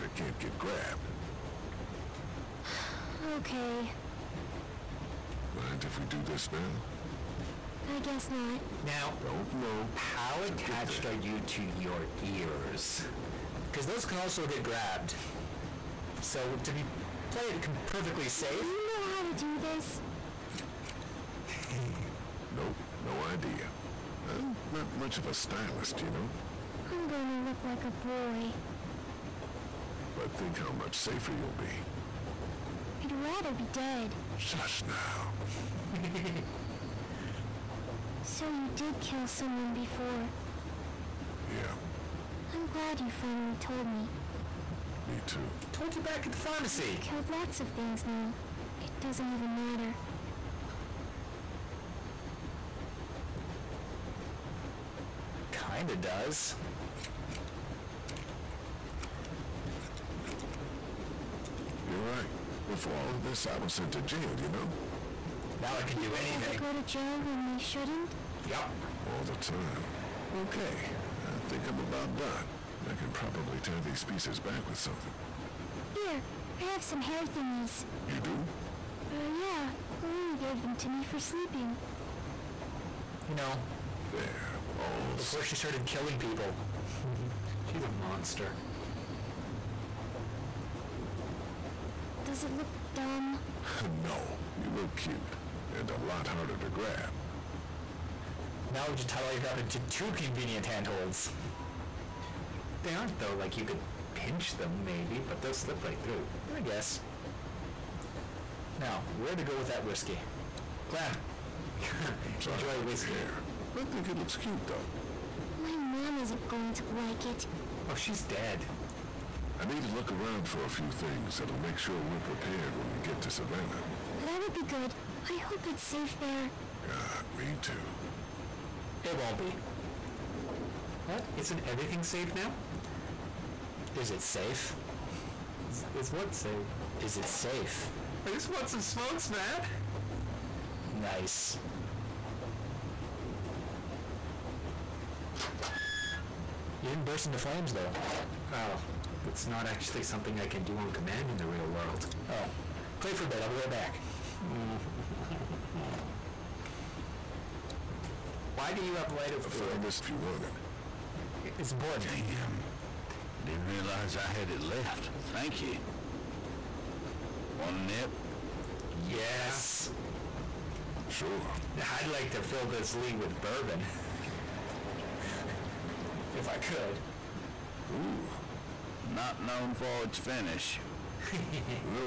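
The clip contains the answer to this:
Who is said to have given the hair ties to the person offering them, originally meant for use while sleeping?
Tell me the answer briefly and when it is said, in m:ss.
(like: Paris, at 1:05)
Lily, at 1:20.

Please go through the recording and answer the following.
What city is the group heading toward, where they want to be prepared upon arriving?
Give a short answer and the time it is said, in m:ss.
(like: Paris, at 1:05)
Savannah, at 2:03.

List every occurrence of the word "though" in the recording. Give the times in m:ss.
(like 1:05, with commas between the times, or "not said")
1:43, 1:54, 2:27.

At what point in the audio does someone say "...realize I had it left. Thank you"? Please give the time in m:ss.
2:43.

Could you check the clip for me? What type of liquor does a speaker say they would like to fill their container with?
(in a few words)
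Bourbon.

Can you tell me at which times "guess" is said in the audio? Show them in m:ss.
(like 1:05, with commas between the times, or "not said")
0:07, 1:46.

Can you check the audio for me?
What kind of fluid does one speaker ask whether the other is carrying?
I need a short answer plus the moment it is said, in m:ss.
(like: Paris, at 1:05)
Lighter fluid, at 2:39.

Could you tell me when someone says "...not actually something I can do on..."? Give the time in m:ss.
2:29.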